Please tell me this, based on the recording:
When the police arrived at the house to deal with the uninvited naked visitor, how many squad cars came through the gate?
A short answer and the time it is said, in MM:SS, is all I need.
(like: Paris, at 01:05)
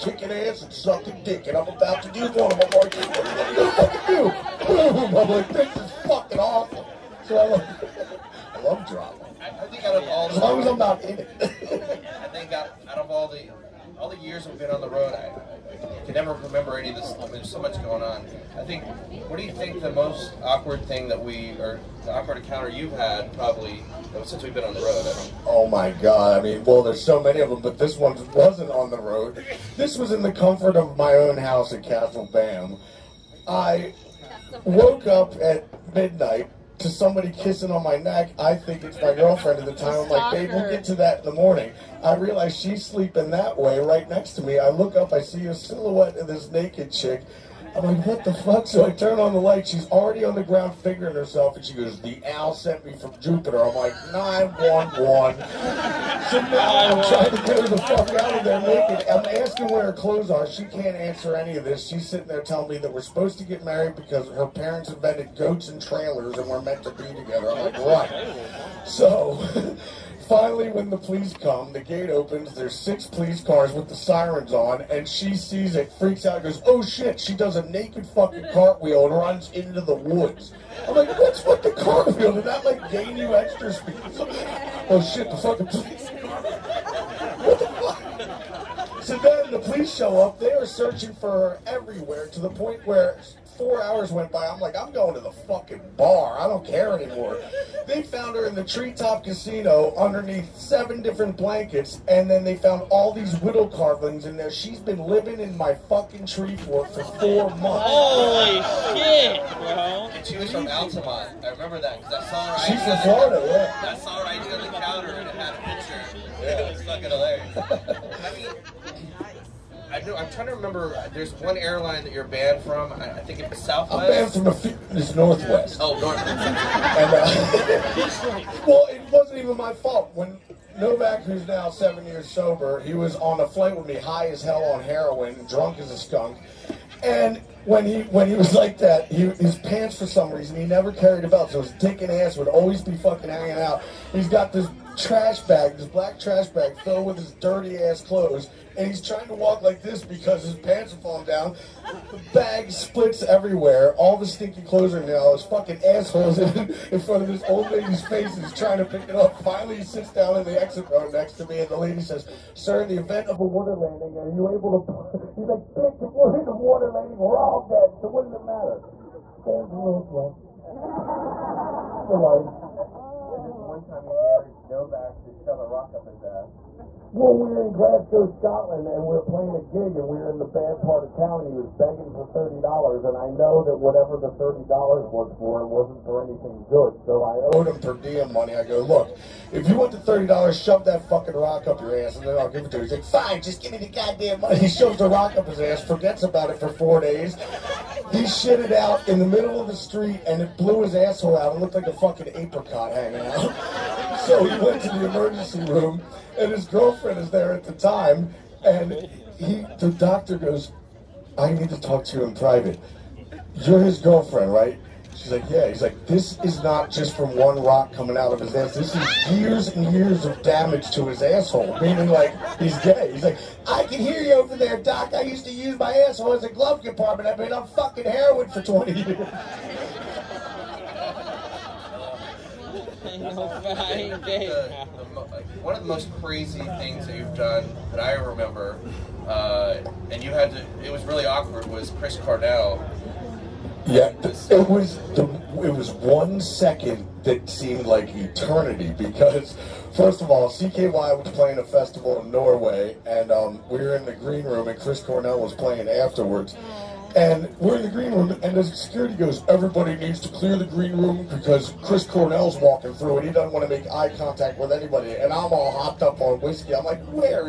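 6, at 01:12.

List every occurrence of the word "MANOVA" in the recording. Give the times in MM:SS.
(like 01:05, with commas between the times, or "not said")
not said.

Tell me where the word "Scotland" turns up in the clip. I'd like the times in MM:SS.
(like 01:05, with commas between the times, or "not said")
02:58.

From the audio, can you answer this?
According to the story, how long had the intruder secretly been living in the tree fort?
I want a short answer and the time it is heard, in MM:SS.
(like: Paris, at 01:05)
4 months, at 01:47.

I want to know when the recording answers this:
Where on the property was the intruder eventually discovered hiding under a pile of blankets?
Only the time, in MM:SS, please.
01:38.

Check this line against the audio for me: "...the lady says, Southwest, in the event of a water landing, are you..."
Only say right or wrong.
wrong.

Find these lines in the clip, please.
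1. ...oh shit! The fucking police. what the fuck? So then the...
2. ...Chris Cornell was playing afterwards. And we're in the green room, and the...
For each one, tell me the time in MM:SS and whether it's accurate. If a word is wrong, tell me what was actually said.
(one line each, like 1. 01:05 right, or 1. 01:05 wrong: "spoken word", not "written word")
1. 01:24 right
2. 04:14 right.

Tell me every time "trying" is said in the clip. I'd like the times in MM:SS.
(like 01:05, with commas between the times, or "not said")
00:57, 02:00, 02:29, 02:38.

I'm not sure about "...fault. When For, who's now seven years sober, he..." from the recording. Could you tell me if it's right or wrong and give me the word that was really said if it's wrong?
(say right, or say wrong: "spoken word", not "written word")
wrong: "Novak", not "For".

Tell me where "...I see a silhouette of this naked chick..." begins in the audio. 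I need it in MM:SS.
00:45.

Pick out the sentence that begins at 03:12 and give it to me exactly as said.
He's like, fine, just give me the goddamn money.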